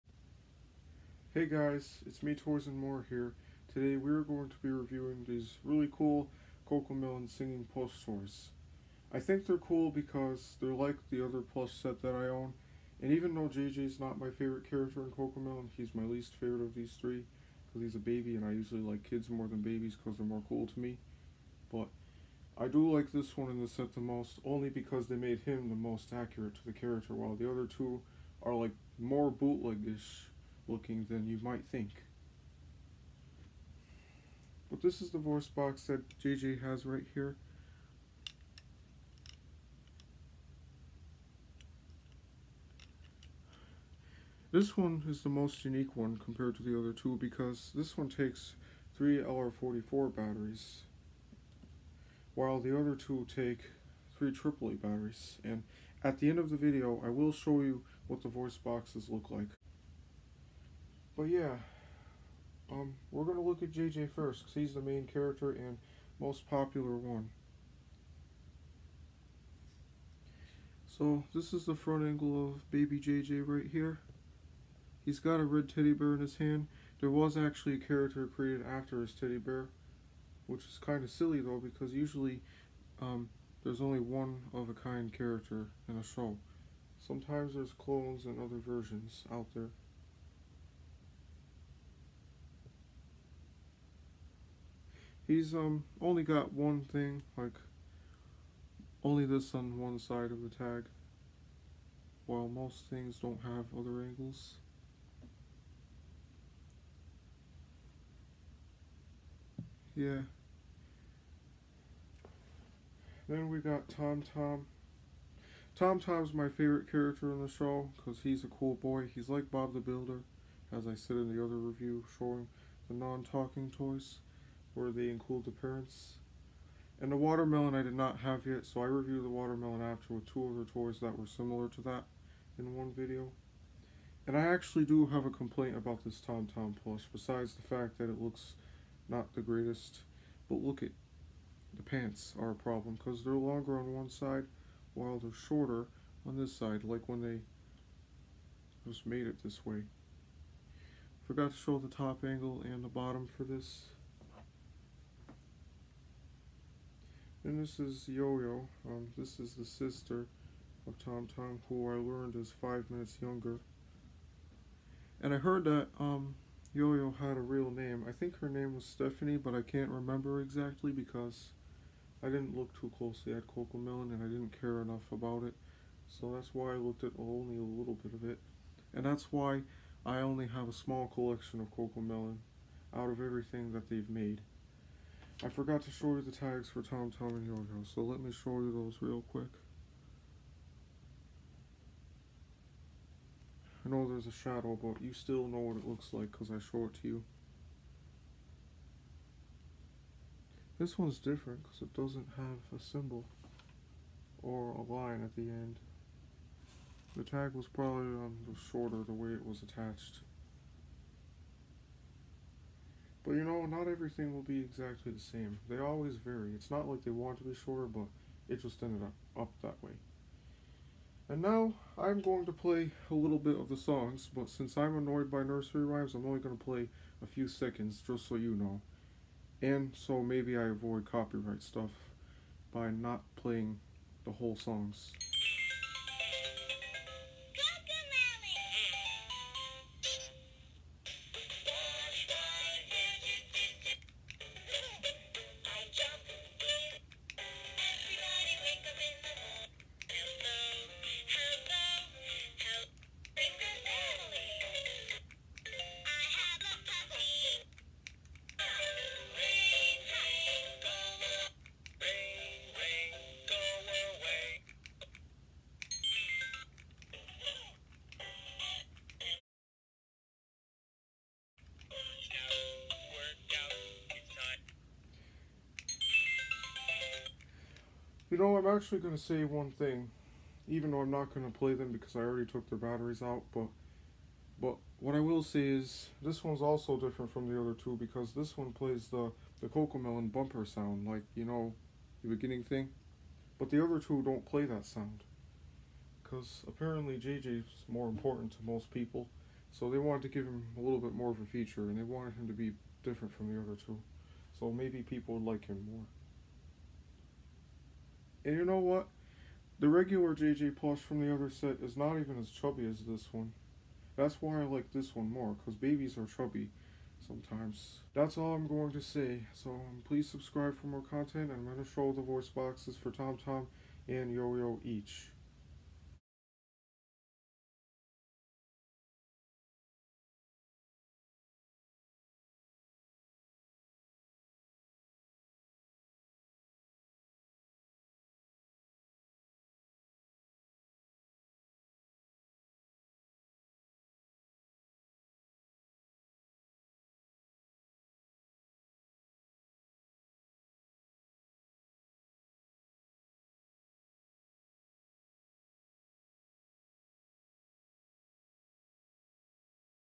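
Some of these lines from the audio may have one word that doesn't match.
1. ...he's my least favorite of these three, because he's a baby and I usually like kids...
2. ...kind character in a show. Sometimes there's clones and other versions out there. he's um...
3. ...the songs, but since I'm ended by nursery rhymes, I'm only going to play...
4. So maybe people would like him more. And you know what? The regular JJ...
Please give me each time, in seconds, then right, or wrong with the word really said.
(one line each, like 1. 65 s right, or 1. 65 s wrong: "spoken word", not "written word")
1. 15 s right
2. 84 s right
3. 223 s wrong: "annoyed", not "ended"
4. 304 s right.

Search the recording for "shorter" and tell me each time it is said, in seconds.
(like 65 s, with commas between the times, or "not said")
145 s, 208 s, 217 s.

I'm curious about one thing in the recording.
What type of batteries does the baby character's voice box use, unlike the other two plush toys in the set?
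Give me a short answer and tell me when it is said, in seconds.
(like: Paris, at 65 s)
LR44, at 48 s.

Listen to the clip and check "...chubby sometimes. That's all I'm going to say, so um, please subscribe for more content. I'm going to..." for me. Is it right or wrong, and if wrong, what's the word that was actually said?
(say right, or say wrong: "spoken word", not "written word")
right.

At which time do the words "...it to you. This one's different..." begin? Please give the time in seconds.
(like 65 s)
196 s.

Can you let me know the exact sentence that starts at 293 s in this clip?
But the other two don't play that sound.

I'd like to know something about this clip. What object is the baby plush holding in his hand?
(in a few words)
Red teddy bear.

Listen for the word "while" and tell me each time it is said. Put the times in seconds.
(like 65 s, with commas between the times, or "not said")
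27 s, 52 s, 102 s, 144 s.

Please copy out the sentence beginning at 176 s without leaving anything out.
So that's why I looked at only a little bit of it.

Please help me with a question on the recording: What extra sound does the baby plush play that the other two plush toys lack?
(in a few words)
Cocomelon bumper sound.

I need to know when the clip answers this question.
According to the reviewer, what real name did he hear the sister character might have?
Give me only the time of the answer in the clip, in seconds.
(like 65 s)
168 s.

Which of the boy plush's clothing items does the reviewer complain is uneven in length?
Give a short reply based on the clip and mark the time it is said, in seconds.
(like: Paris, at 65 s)
The pants, at 141 s.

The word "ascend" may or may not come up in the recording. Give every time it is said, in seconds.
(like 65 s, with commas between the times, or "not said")
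not said.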